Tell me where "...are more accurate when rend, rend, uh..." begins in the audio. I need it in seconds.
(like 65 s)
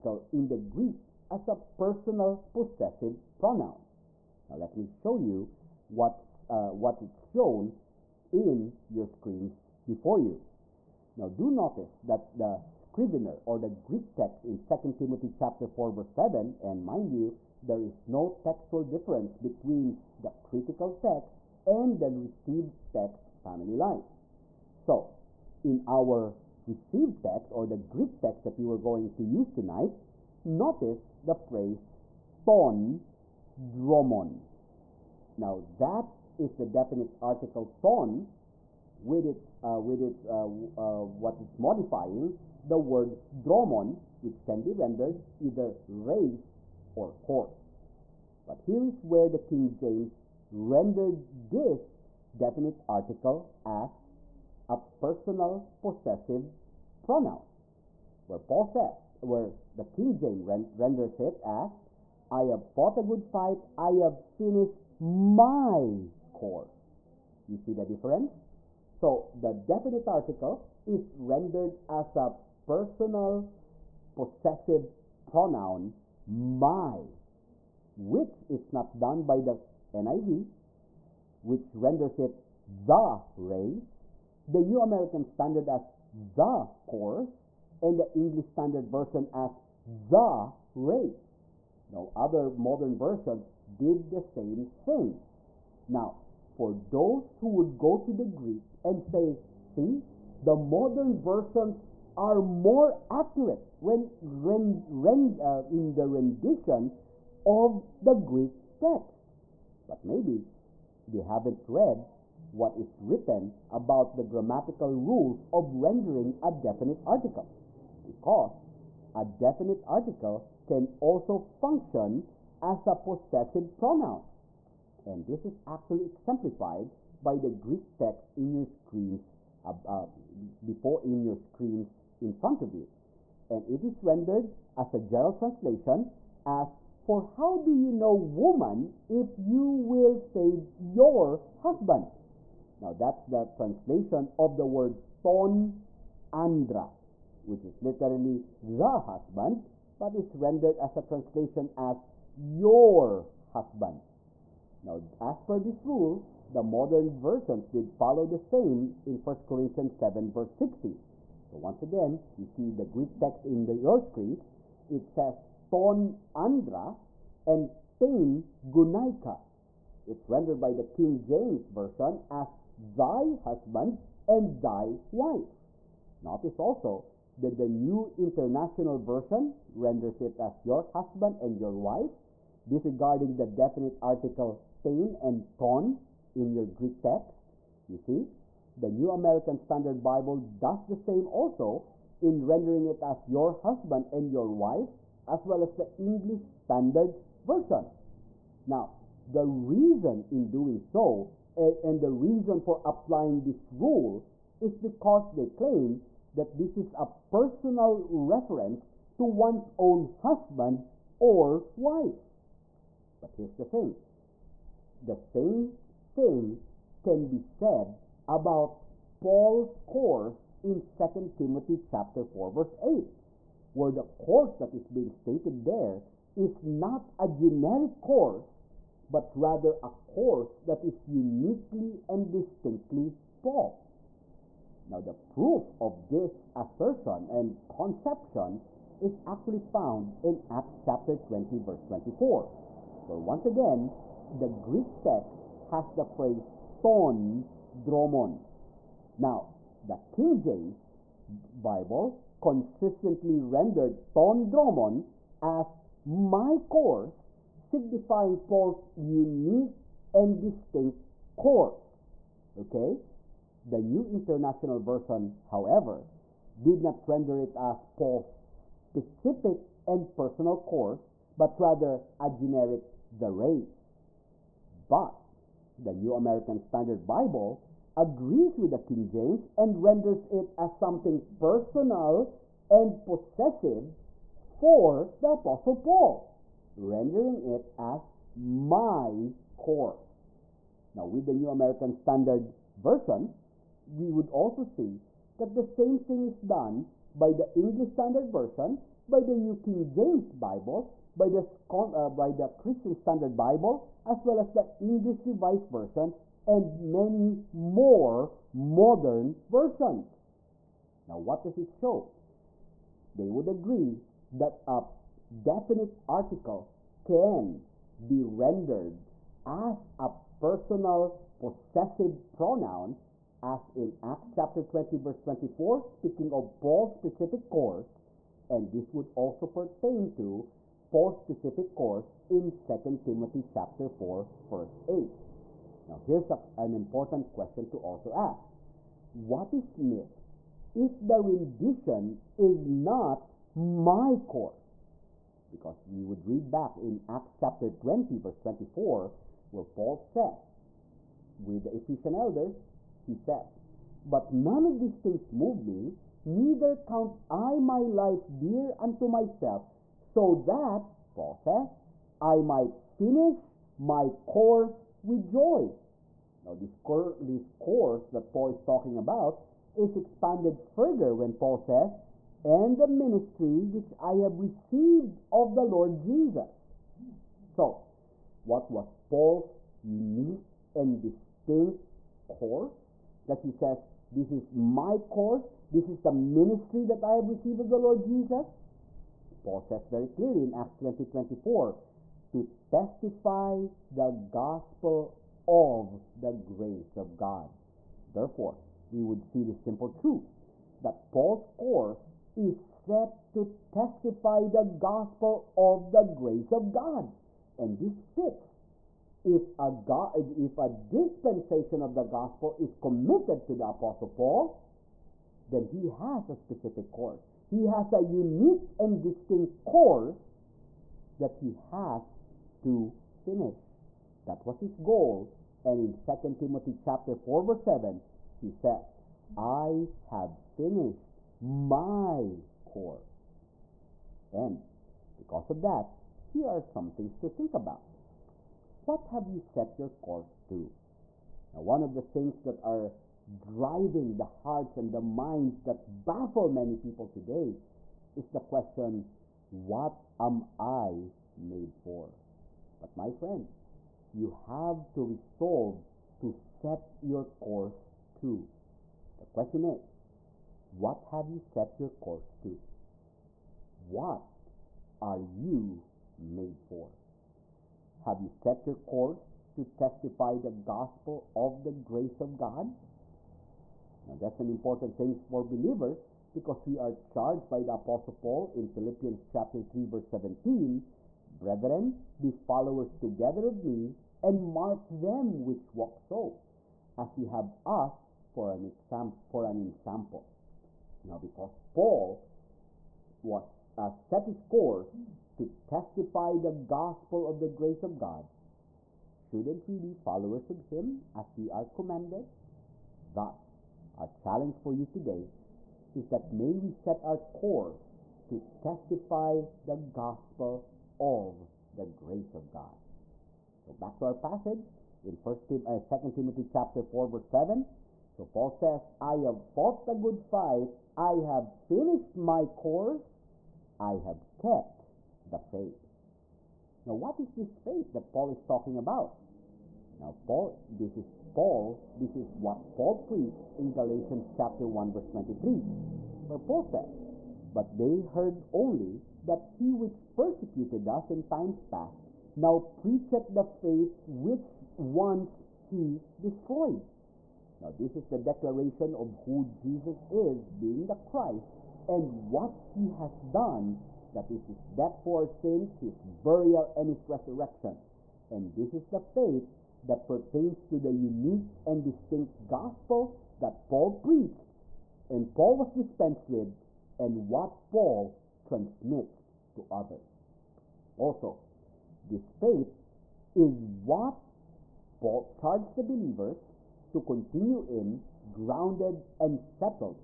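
102 s.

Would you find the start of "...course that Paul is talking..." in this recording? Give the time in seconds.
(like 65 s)
367 s.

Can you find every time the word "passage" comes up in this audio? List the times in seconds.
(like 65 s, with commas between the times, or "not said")
514 s.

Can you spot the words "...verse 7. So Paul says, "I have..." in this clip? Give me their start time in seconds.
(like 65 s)
517 s.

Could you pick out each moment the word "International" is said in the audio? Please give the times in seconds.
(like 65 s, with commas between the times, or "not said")
178 s, 264 s.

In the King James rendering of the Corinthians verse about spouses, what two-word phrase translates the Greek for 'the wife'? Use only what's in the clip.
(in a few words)
thy wife.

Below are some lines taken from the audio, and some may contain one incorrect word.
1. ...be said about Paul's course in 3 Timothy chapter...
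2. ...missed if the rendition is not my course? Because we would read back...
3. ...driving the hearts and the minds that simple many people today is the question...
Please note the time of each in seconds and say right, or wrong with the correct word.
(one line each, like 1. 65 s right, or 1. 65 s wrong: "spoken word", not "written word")
1. 217 s wrong: "2", not "3"
2. 339 s right
3. 443 s wrong: "baffle", not "simple".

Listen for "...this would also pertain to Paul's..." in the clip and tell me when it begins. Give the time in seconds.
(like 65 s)
328 s.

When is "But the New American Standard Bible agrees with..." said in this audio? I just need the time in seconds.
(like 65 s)
274 s.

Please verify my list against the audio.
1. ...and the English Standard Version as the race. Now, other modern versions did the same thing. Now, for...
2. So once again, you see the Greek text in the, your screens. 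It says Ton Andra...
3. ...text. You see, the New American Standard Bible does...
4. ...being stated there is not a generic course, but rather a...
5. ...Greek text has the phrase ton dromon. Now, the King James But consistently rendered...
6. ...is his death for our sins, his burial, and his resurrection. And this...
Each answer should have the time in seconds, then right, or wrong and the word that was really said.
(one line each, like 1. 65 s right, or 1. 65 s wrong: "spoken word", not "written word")
1. 87 s right
2. 161 s right
3. 187 s right
4. 224 s right
5. 244 s wrong: "Bible", not "But"
6. 554 s right.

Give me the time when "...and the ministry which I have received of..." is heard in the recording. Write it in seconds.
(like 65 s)
372 s.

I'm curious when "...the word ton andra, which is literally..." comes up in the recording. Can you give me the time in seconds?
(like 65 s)
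144 s.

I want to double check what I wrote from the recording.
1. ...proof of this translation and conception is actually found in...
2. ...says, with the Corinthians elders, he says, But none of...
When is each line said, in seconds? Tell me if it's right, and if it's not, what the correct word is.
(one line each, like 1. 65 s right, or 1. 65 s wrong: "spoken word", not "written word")
1. 235 s wrong: "assertion", not "translation"
2. 349 s wrong: "Ephesian", not "Corinthians".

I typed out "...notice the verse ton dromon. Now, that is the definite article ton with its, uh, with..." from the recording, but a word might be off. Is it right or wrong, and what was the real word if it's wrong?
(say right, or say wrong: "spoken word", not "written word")
wrong: "phrase", not "verse".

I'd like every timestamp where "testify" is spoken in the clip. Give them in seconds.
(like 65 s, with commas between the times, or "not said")
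392 s, 403 s, 469 s, 495 s, 508 s.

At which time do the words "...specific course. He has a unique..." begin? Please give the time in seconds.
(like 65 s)
416 s.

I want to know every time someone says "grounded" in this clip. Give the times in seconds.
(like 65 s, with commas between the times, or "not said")
578 s.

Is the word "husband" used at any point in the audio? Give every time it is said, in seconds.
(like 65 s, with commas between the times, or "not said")
141 s, 149 s, 153 s, 173 s, 180 s, 193 s, 210 s.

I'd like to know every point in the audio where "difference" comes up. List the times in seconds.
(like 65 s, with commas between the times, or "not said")
18 s, 67 s.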